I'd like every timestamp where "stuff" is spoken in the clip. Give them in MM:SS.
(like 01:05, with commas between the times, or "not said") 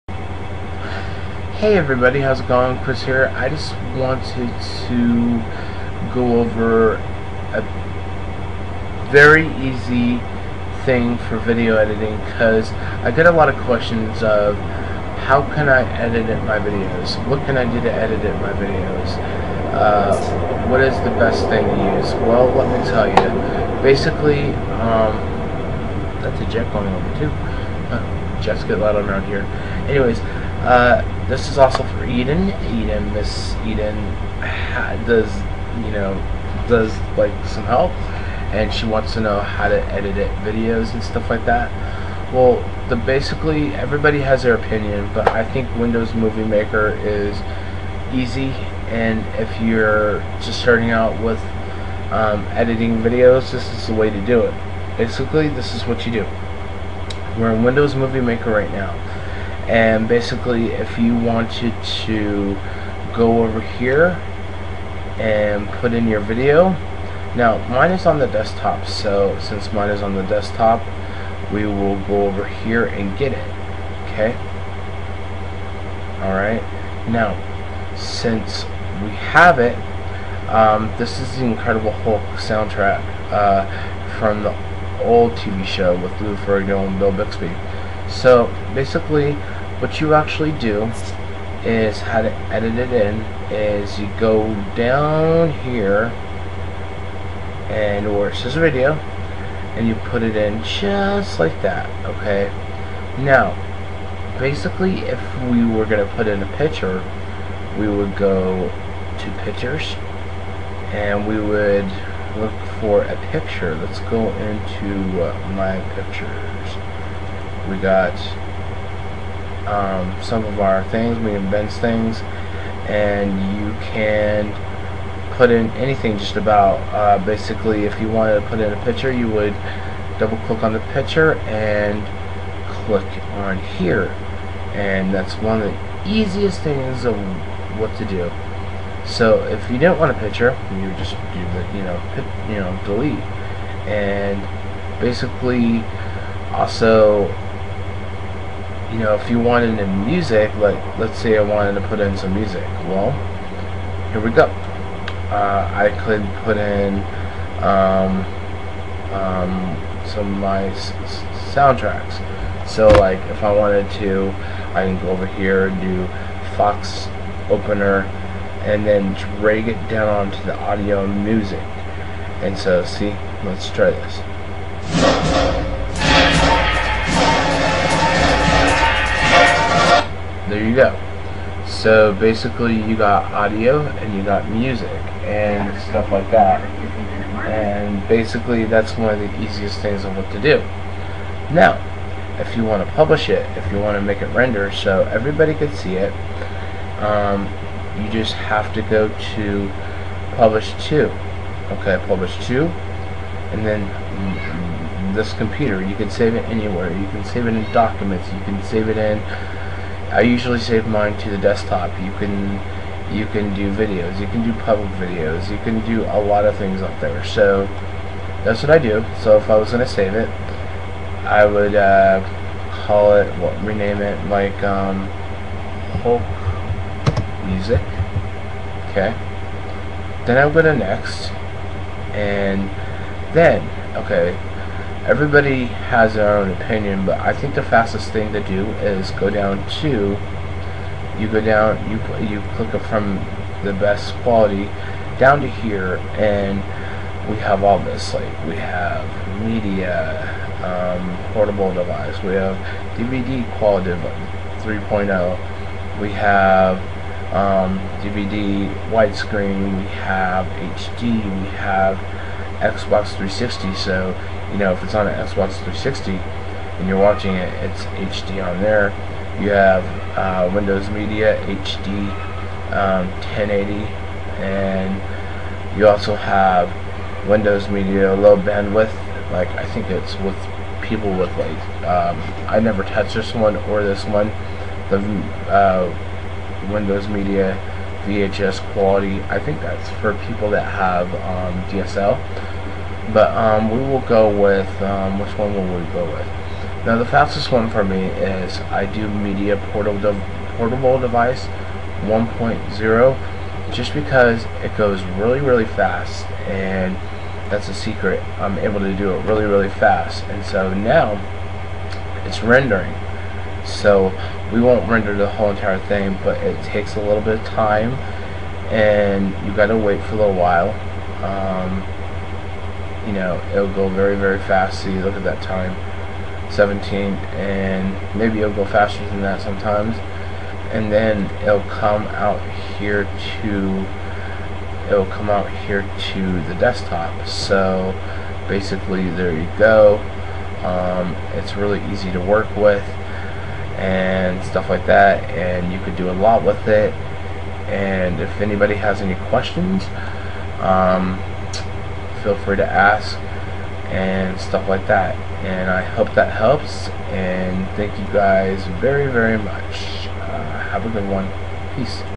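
00:41, 03:05, 05:44, 05:54.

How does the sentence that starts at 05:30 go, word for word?
And then it'll come out here to, it'll come out here to the desktop.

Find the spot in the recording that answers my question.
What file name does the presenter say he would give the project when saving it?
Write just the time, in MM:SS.
03:46.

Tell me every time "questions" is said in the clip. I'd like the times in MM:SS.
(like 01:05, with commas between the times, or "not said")
00:13, 05:49.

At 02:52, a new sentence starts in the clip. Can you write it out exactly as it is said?
And so see, let's try this.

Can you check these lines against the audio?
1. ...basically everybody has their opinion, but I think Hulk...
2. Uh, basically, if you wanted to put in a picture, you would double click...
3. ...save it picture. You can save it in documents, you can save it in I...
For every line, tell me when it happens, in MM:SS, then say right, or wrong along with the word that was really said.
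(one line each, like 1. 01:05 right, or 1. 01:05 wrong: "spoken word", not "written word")
1. 00:42 wrong: "Windows", not "Hulk"
2. 02:06 right
3. 03:26 wrong: "anywhere", not "picture".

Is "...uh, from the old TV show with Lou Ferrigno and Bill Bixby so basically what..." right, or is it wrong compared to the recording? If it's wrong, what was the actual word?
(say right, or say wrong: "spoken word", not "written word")
right.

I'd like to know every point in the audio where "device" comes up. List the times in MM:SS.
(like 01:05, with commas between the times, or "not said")
04:11, 05:00.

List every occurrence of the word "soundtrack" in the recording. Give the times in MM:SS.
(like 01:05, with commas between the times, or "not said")
01:22, 02:41.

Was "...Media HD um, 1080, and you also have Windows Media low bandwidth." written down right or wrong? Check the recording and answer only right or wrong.
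right.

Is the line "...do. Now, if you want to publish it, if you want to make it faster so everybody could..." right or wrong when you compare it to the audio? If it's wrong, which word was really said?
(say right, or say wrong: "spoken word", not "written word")
wrong: "render", not "faster".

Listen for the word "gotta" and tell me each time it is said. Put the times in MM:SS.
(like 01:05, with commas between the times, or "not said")
05:19.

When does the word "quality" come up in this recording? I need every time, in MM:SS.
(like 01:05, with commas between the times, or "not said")
04:04, 04:13, 04:48.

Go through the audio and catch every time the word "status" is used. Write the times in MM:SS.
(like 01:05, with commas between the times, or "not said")
not said.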